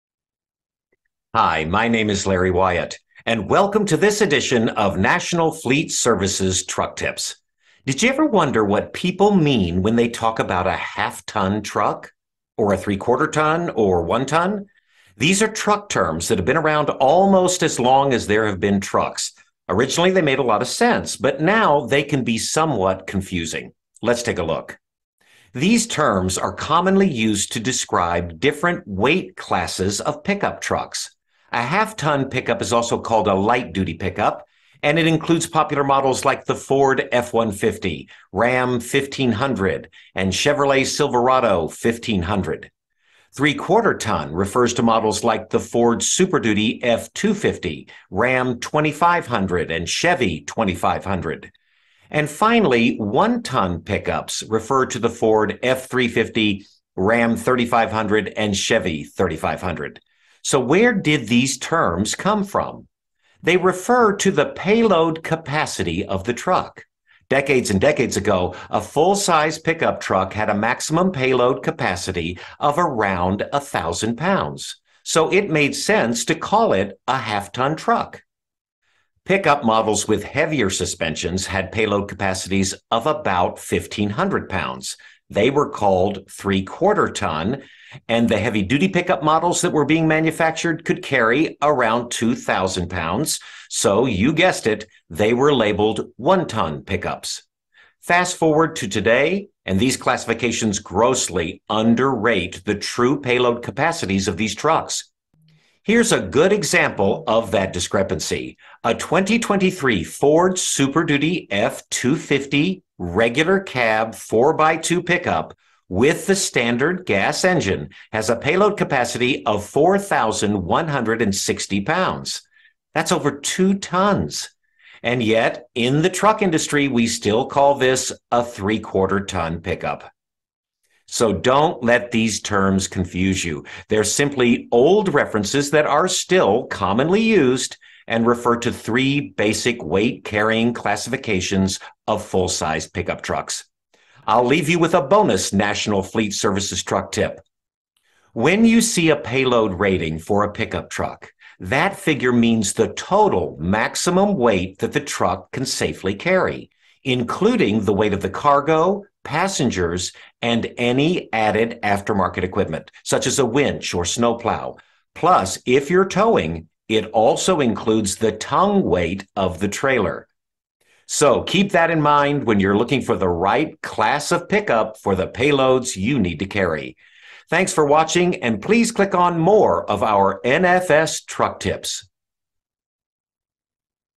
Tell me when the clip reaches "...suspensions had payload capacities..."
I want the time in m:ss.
1:20.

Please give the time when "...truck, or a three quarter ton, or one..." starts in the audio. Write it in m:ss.
0:11.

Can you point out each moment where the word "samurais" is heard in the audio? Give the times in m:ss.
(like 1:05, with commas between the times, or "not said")
not said.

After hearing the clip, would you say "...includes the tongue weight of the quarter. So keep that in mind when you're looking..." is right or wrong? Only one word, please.
wrong.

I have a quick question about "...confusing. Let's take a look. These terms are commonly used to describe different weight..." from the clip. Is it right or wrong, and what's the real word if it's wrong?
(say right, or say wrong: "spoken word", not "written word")
right.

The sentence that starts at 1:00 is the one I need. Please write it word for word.
So where did these terms come from?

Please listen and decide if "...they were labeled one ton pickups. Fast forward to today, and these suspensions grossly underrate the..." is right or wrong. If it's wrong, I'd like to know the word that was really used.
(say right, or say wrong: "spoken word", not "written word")
wrong: "classifications", not "suspensions".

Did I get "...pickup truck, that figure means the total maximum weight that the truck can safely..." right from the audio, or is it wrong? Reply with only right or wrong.
right.